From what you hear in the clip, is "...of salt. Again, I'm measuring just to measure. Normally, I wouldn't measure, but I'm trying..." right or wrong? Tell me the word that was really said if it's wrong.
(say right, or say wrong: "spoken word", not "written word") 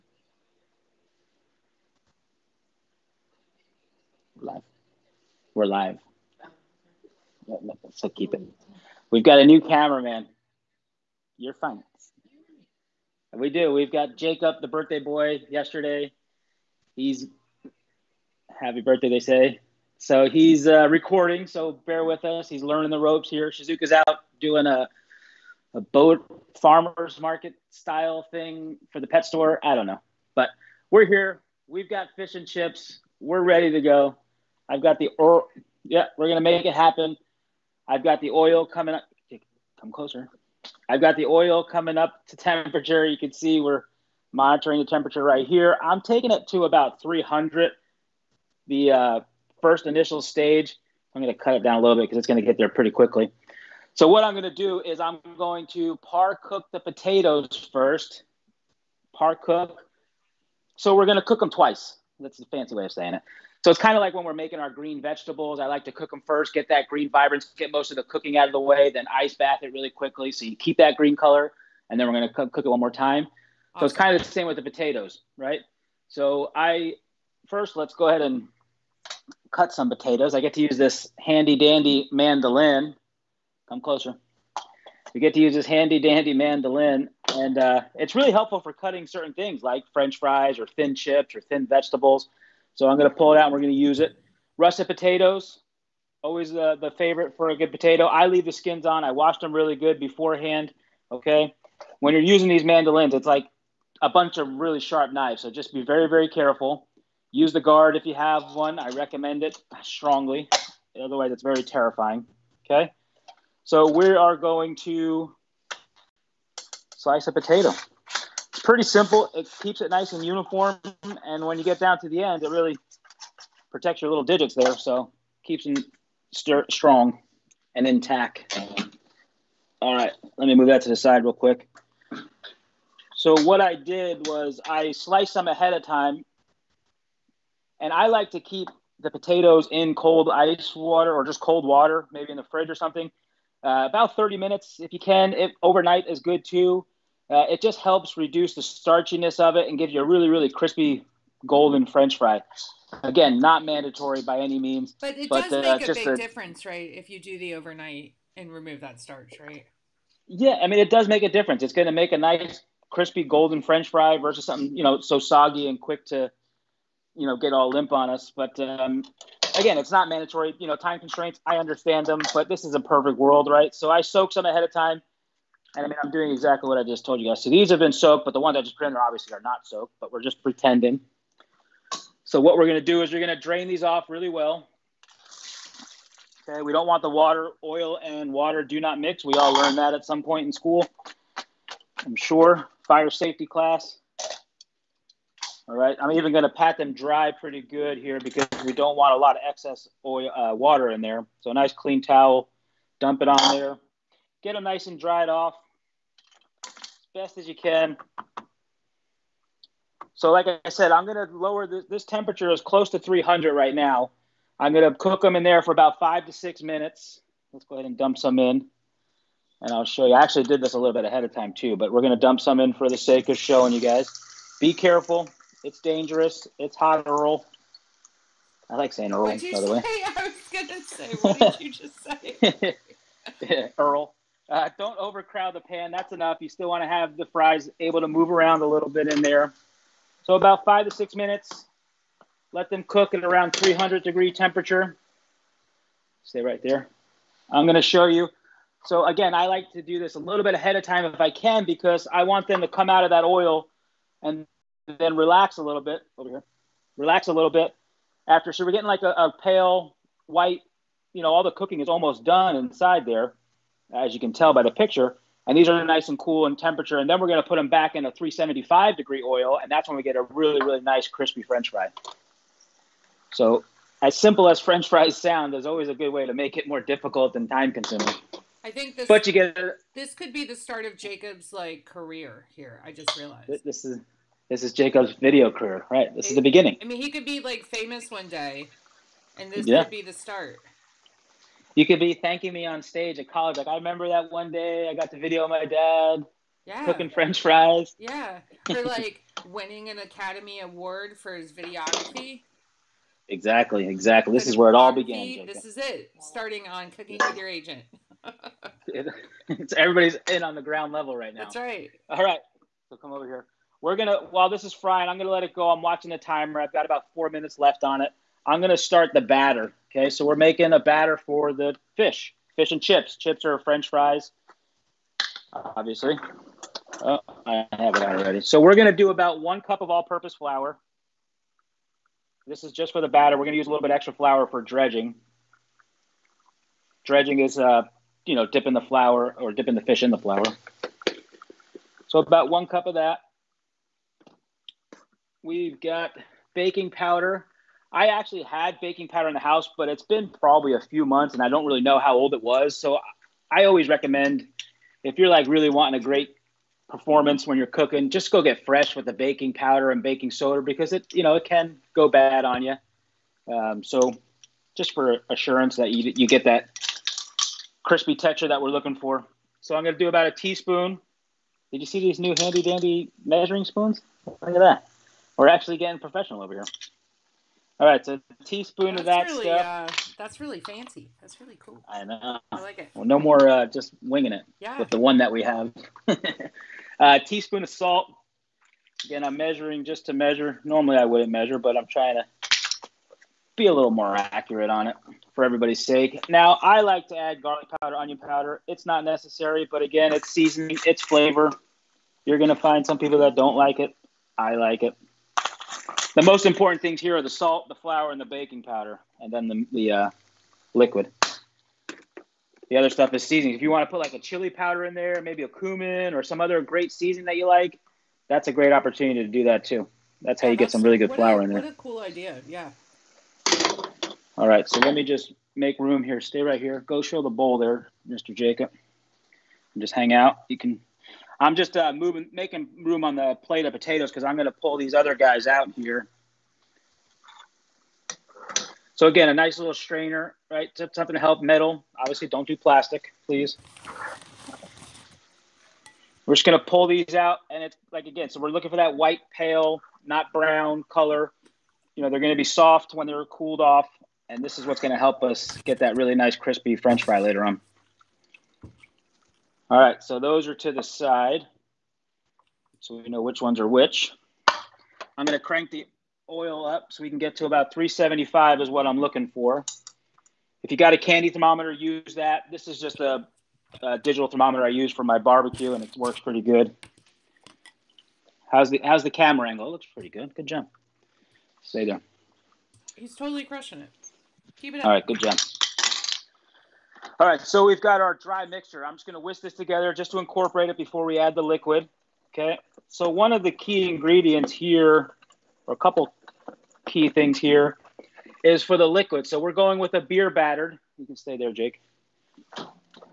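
right.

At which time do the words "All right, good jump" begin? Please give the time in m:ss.
8:04.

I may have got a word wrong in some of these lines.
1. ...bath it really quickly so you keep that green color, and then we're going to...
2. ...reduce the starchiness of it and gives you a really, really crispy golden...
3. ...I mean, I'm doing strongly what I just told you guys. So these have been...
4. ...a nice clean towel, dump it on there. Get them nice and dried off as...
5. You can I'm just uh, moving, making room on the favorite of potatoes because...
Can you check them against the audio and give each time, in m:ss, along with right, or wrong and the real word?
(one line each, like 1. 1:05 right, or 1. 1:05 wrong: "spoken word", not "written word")
1. 1:09 right
2. 2:28 right
3. 2:55 wrong: "exactly", not "strongly"
4. 3:21 right
5. 7:10 wrong: "plate", not "favorite".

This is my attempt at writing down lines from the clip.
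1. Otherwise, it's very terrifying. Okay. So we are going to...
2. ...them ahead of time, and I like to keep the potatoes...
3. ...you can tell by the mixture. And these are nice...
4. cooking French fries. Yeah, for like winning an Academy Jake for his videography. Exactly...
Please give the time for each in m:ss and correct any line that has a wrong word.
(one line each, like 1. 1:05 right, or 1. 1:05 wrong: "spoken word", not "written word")
1. 1:50 right
2. 2:15 right
3. 4:24 wrong: "picture", not "mixture"
4. 4:56 wrong: "Award", not "Jake".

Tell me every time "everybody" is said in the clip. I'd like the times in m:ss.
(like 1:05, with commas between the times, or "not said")
5:09, 6:35.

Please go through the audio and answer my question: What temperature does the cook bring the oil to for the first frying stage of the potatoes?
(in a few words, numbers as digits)
300.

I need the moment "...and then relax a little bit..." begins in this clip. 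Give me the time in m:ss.
4:14.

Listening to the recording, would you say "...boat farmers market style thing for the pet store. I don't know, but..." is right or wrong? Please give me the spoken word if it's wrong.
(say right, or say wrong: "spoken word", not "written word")
right.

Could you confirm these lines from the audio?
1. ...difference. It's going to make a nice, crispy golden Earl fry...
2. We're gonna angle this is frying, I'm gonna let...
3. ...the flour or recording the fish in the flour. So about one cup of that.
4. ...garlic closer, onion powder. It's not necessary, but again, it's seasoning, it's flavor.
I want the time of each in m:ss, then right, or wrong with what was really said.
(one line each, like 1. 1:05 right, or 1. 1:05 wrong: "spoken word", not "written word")
1. 2:41 wrong: "French", not "Earl"
2. 5:13 wrong: "while", not "angle"
3. 5:38 wrong: "dipping", not "recording"
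4. 6:37 wrong: "powder", not "closer".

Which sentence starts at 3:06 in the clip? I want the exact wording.
Okay, we don't want the water, oil, and water do not mix.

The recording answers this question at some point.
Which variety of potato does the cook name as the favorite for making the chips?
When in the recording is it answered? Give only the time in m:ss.
1:34.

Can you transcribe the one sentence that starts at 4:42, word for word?
I just realized this is this is Jacob's video career, right?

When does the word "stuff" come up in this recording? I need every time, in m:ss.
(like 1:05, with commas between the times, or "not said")
6:19, 6:52.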